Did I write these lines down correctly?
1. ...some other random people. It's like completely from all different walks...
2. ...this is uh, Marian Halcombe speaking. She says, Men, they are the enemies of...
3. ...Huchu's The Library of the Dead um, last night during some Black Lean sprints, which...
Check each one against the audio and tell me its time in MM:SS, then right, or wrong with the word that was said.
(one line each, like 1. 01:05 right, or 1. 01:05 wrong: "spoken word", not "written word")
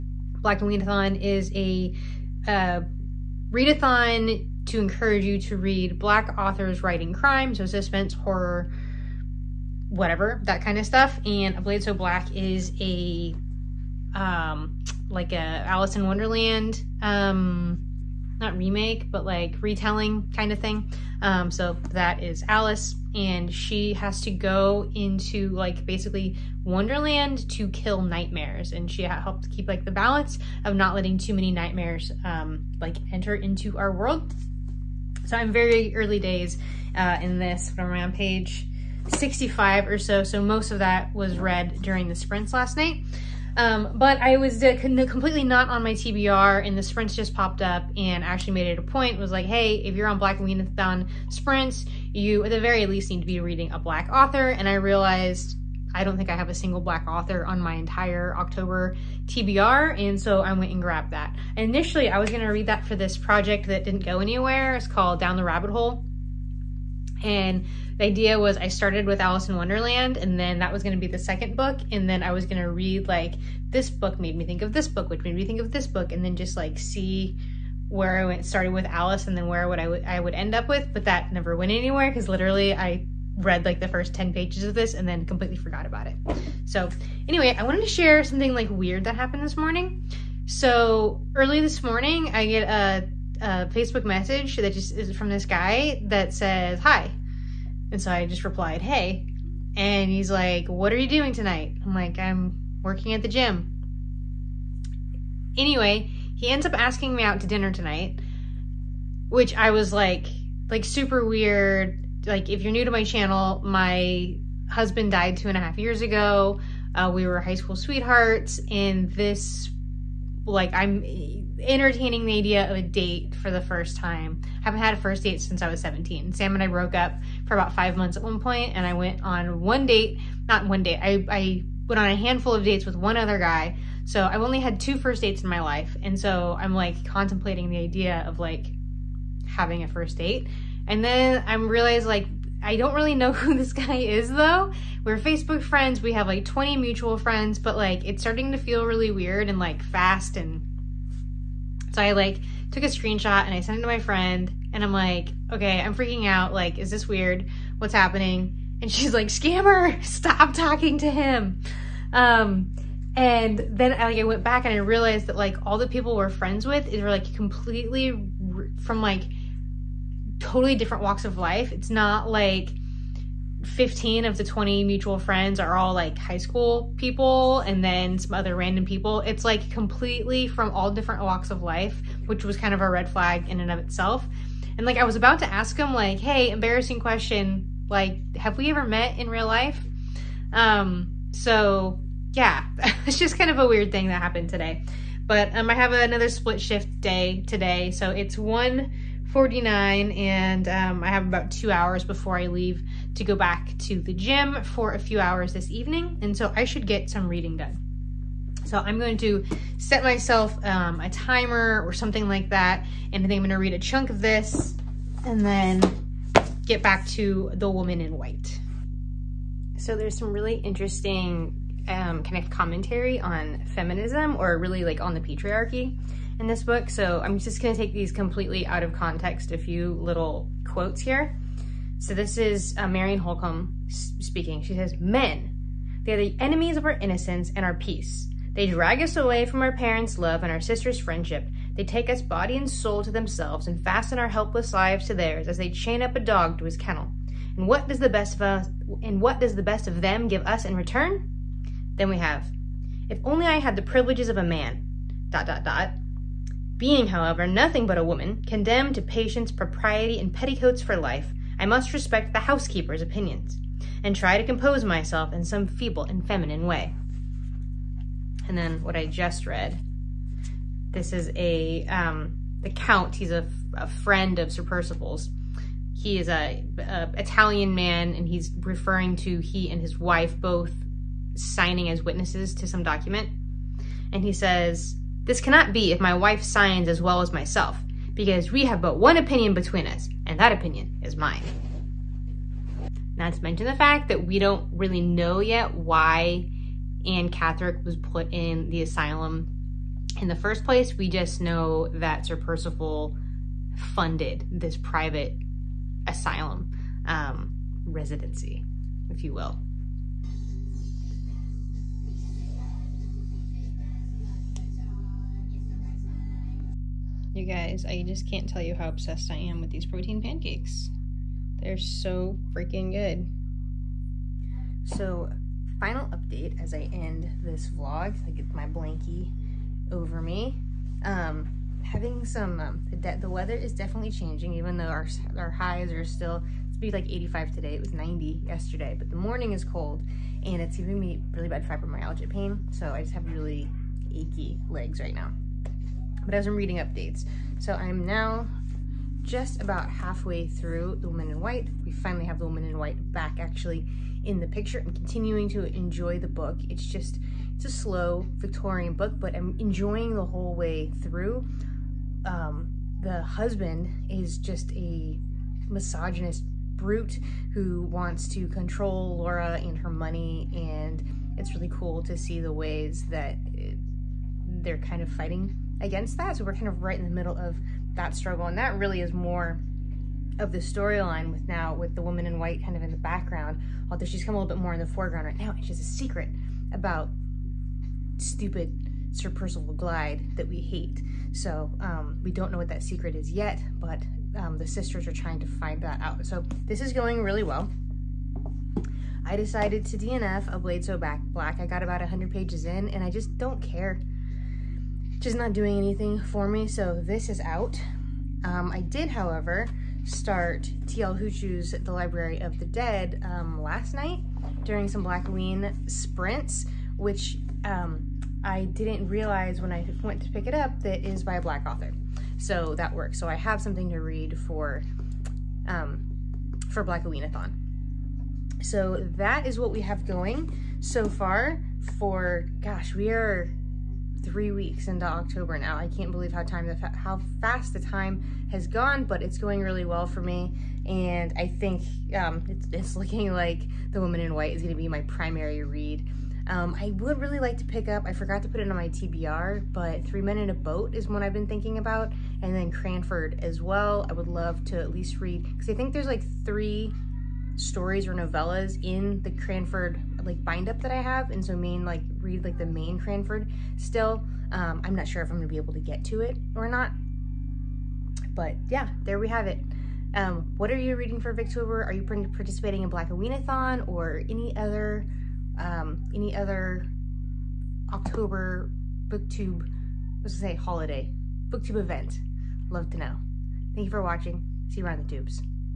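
1. 02:58 right
2. 03:52 right
3. 06:51 right.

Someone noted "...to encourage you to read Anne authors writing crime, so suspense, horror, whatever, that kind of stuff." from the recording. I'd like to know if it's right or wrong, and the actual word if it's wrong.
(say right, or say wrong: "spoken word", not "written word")
wrong: "Black", not "Anne".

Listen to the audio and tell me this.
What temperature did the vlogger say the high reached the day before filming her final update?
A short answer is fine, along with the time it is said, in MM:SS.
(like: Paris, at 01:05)
90, at 05:37.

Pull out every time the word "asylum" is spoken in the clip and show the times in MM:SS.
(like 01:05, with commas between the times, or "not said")
04:58, 05:06.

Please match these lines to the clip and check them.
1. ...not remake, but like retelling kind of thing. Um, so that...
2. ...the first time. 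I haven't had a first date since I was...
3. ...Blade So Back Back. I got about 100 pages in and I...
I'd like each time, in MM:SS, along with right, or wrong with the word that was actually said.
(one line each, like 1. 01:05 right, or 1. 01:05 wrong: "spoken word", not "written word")
1. 00:18 right
2. 02:03 right
3. 06:40 wrong: "Black", not "Back".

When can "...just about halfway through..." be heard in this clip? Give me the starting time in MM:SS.
05:49.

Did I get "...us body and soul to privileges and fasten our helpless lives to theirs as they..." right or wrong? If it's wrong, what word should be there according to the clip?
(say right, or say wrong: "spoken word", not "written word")
wrong: "themselves", not "privileges".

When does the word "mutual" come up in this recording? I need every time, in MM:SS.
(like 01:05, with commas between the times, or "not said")
02:26, 02:54.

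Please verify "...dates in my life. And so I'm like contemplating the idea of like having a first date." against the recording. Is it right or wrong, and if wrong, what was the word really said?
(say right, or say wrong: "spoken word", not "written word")
right.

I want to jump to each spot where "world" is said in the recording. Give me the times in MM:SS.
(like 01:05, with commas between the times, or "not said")
00:33.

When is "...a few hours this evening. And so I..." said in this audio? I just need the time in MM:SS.
03:24.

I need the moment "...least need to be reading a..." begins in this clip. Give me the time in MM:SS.
00:52.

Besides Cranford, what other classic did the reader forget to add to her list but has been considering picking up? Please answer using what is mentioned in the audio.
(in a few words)
Three Men in a Boat.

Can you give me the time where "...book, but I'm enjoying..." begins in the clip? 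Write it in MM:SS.
05:58.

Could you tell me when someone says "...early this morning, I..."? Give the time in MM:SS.
01:31.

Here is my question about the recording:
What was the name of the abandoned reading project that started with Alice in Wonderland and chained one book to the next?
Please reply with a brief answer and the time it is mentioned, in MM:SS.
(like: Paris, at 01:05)
Down the Rabbit Hole, at 01:05.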